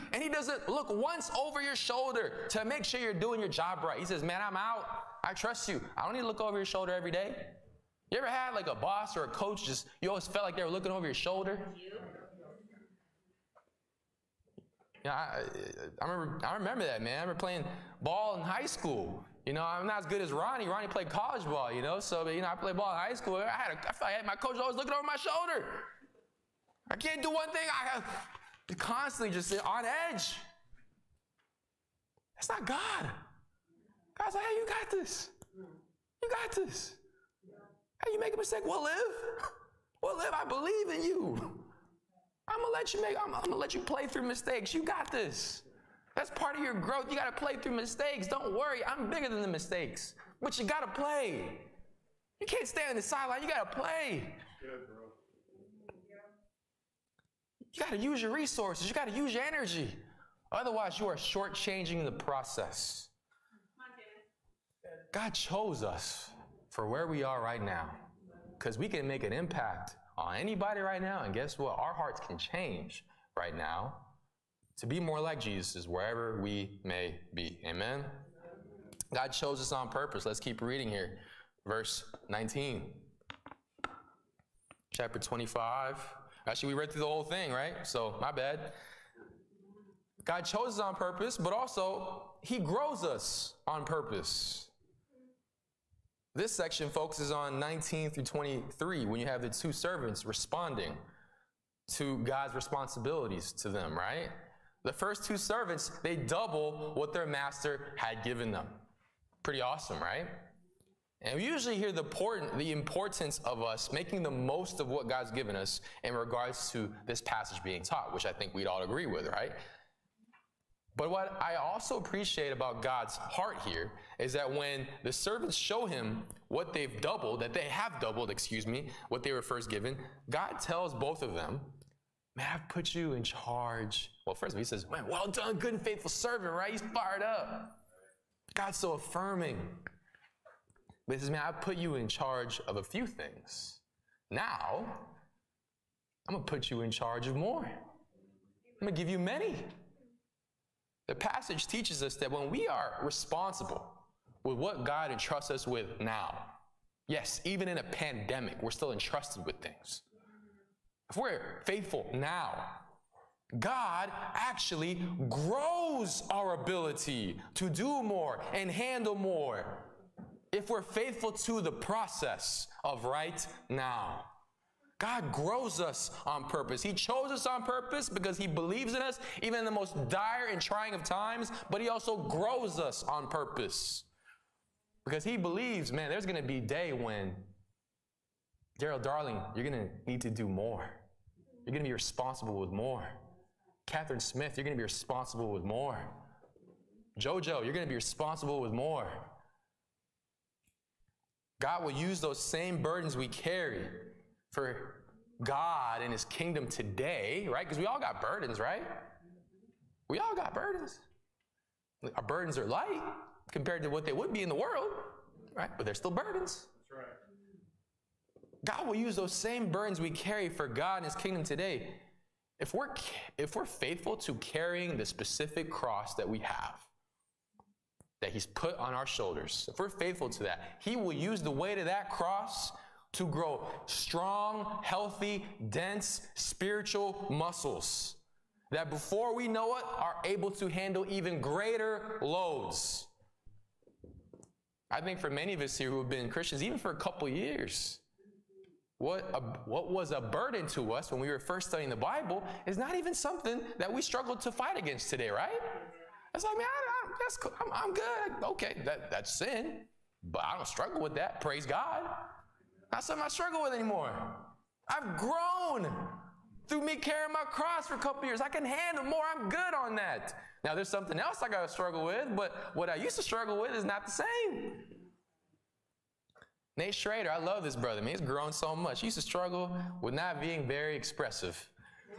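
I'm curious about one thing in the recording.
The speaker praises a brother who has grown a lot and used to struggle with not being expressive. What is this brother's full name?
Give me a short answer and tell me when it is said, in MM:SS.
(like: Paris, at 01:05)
Nate Schrader, at 04:36.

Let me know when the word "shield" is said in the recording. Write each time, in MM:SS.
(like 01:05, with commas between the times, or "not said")
not said.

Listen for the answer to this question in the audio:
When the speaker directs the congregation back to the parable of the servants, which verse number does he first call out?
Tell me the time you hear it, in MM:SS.
01:21.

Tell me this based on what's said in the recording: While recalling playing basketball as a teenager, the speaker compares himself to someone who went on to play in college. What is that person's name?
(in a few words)
Ronnie.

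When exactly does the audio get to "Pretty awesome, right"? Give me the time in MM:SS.
01:49.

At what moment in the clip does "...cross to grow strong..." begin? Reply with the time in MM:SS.
03:52.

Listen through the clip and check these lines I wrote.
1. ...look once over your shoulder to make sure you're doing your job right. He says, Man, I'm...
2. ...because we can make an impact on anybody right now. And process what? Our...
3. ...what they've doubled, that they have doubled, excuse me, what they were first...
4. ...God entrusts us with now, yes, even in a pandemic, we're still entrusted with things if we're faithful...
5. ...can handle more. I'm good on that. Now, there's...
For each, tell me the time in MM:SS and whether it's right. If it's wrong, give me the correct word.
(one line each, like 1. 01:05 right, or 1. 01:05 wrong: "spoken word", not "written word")
1. 00:00 right
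2. 01:08 wrong: "guess", not "process"
3. 02:06 right
4. 02:34 right
5. 04:28 right.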